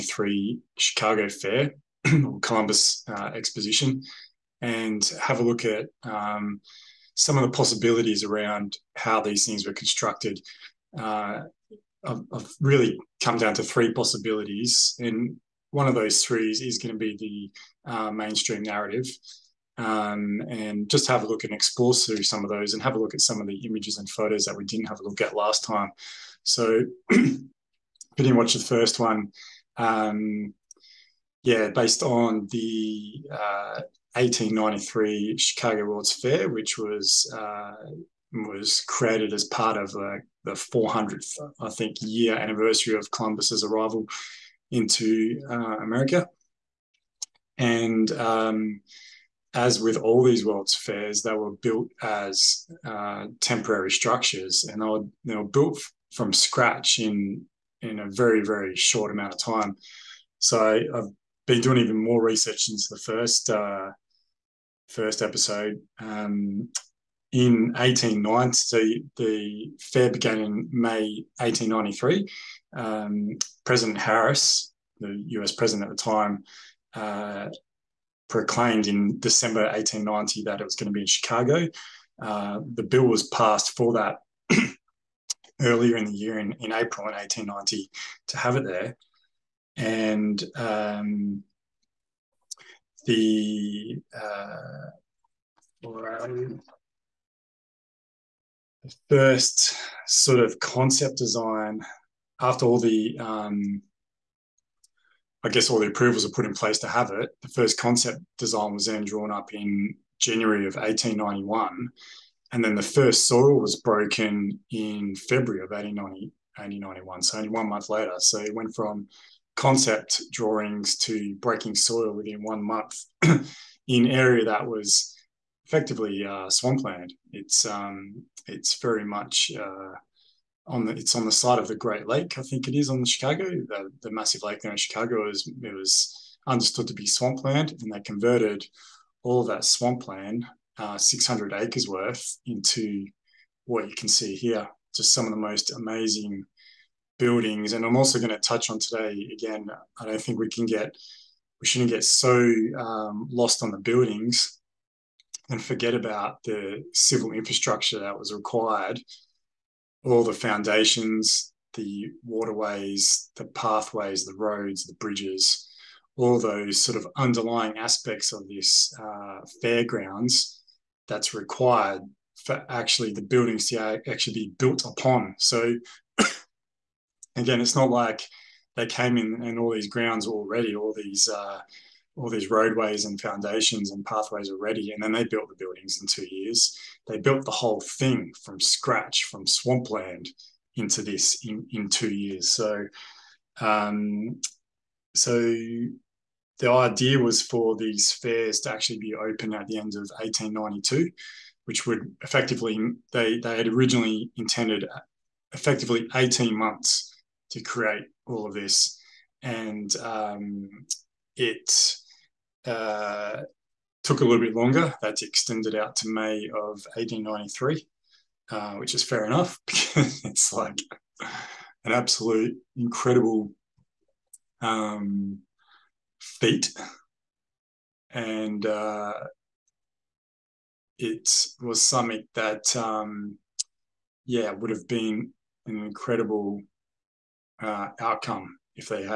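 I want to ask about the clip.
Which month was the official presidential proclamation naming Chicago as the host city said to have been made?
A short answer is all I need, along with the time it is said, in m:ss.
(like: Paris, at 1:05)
December 1890, at 1:19.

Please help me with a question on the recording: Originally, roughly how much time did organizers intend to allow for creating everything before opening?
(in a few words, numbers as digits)
18 months.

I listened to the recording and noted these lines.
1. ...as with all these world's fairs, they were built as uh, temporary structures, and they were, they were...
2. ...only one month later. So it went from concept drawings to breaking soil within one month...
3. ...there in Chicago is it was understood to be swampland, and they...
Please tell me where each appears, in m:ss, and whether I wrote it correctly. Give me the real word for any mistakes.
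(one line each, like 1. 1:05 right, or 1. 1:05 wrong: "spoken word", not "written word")
1. 0:49 right
2. 1:57 right
3. 2:14 right.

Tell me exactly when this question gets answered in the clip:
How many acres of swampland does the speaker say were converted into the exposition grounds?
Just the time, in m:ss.
2:20.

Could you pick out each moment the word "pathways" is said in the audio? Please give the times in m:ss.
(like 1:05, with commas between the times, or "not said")
2:43, 3:04.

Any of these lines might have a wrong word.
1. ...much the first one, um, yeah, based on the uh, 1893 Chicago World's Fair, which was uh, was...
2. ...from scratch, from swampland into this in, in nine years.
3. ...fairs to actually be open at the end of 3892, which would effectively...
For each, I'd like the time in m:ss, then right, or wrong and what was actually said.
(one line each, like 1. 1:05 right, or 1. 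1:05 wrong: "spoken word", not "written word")
1. 0:28 right
2. 3:08 wrong: "two", not "nine"
3. 3:18 wrong: "1892", not "3892".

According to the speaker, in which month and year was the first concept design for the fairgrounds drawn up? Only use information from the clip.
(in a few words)
January 1891.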